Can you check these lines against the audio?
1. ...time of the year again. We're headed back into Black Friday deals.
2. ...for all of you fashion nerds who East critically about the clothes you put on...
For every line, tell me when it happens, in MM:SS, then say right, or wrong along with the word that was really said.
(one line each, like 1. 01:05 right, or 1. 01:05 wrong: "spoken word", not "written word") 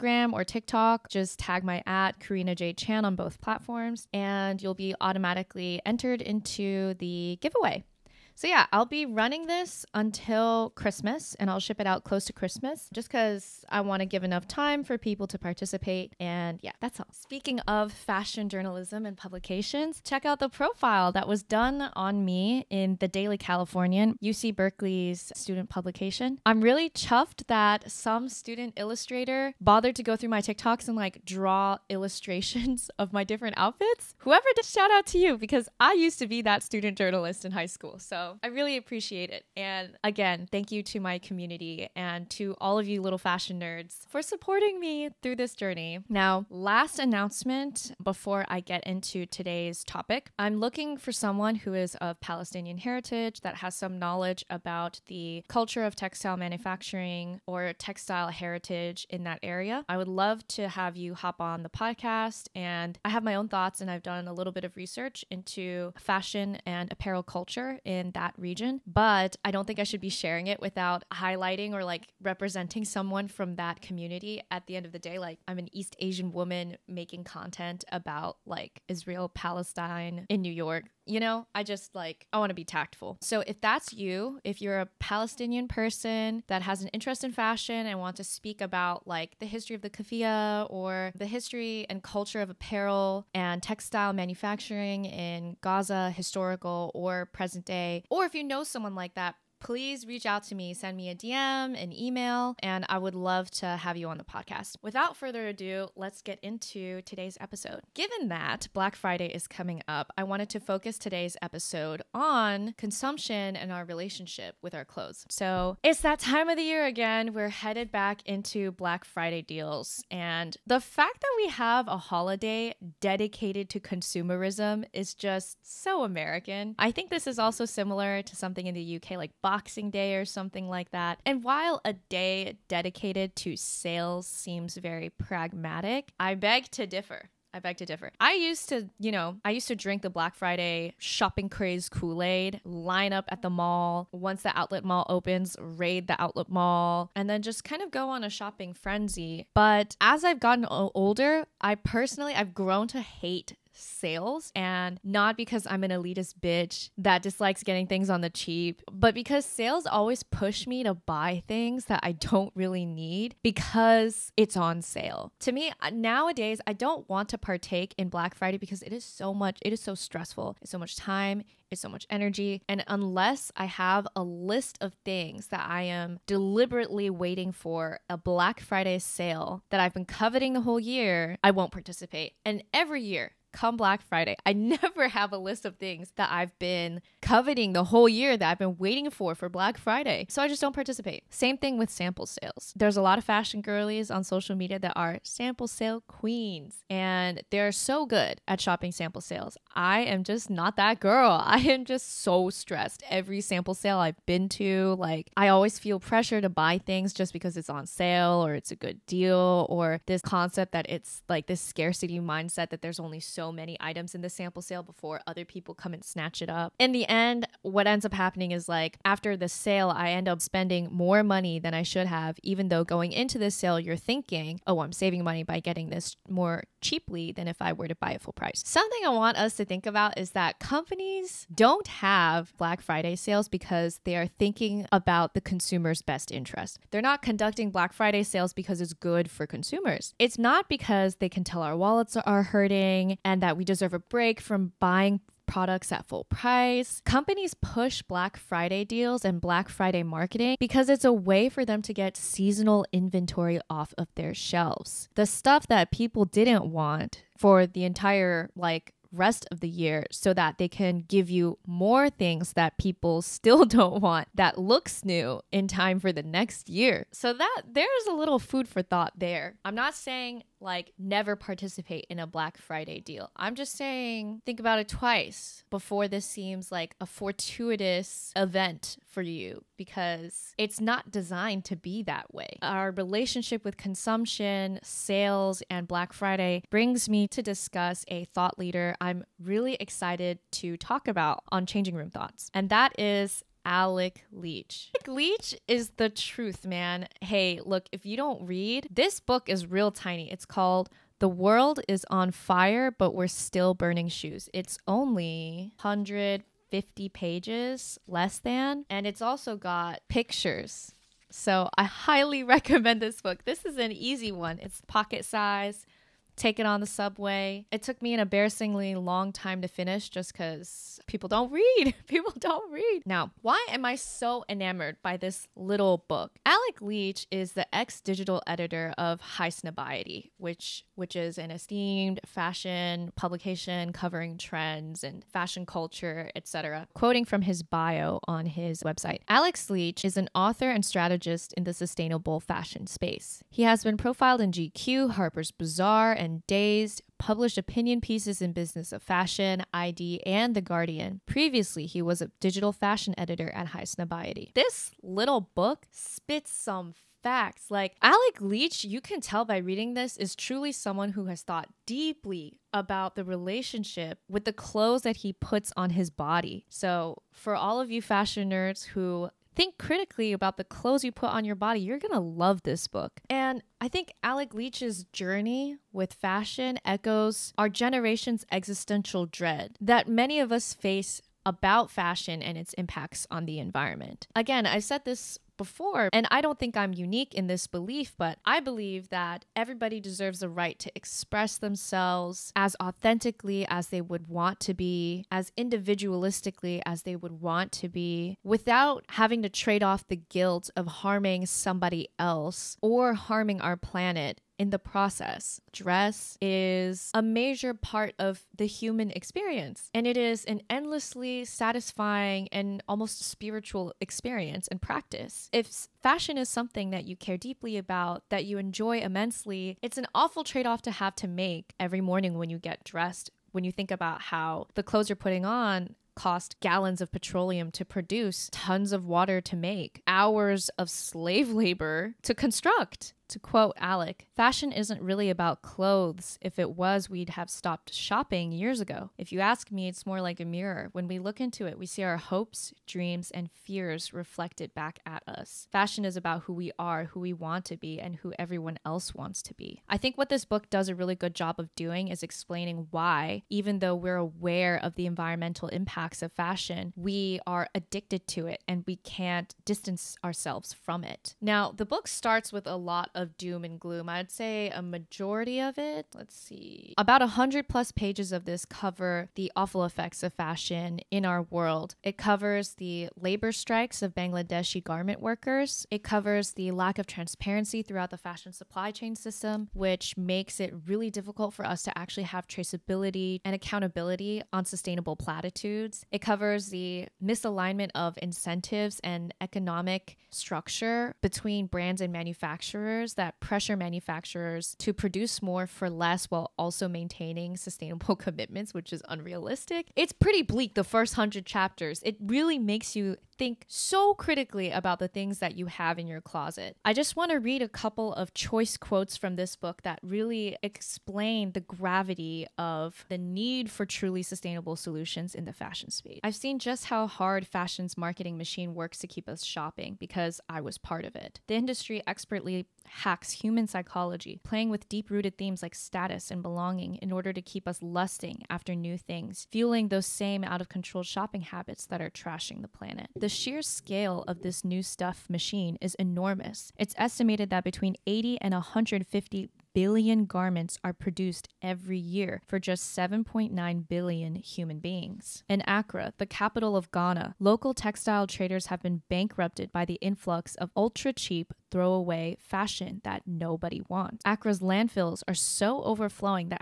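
1. 01:56 right
2. 06:07 wrong: "Think", not "East".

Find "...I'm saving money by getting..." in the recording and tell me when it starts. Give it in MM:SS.
03:44.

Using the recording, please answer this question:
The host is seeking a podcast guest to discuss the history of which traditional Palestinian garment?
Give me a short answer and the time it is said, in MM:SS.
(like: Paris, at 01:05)
keffiyeh, at 01:29.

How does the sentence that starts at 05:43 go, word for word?
He has been profiled in GQ, Harper's Bazaar, and and Dazed, published opinion pieces in Business of Fashion, ID, and The Guardian.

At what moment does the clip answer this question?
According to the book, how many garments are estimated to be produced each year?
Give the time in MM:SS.
08:58.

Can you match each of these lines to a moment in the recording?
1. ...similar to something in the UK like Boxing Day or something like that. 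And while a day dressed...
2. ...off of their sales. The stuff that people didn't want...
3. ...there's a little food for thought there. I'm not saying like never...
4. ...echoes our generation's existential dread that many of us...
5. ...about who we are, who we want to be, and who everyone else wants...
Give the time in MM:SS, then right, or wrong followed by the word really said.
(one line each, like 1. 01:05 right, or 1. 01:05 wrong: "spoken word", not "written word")
1. 02:07 wrong: "dedicated", not "dressed"
2. 04:13 wrong: "shelves", not "sales"
3. 04:27 right
4. 06:16 right
5. 07:26 right.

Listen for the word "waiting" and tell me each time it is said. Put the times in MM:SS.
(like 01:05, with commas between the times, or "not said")
02:57, 03:08.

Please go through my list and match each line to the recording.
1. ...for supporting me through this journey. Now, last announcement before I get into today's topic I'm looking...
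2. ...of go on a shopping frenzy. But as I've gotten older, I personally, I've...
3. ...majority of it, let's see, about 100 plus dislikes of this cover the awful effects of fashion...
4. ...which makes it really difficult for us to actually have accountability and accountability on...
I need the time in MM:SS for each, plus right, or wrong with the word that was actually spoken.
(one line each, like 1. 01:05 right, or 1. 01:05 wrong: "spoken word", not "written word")
1. 00:44 right
2. 02:27 right
3. 07:44 wrong: "pages", not "dislikes"
4. 07:59 wrong: "traceability", not "accountability".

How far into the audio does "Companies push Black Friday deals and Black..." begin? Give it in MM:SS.
04:07.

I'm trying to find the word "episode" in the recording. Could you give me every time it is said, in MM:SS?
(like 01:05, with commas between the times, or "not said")
01:47, 01:51.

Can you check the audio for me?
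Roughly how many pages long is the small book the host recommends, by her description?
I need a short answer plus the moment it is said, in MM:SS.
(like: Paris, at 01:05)
150, at 05:05.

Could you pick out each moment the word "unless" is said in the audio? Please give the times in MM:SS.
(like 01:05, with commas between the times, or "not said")
02:52.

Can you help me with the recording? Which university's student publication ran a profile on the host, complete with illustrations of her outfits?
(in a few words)
UC Berkeley.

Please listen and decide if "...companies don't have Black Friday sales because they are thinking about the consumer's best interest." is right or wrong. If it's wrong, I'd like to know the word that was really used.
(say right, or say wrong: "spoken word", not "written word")
right.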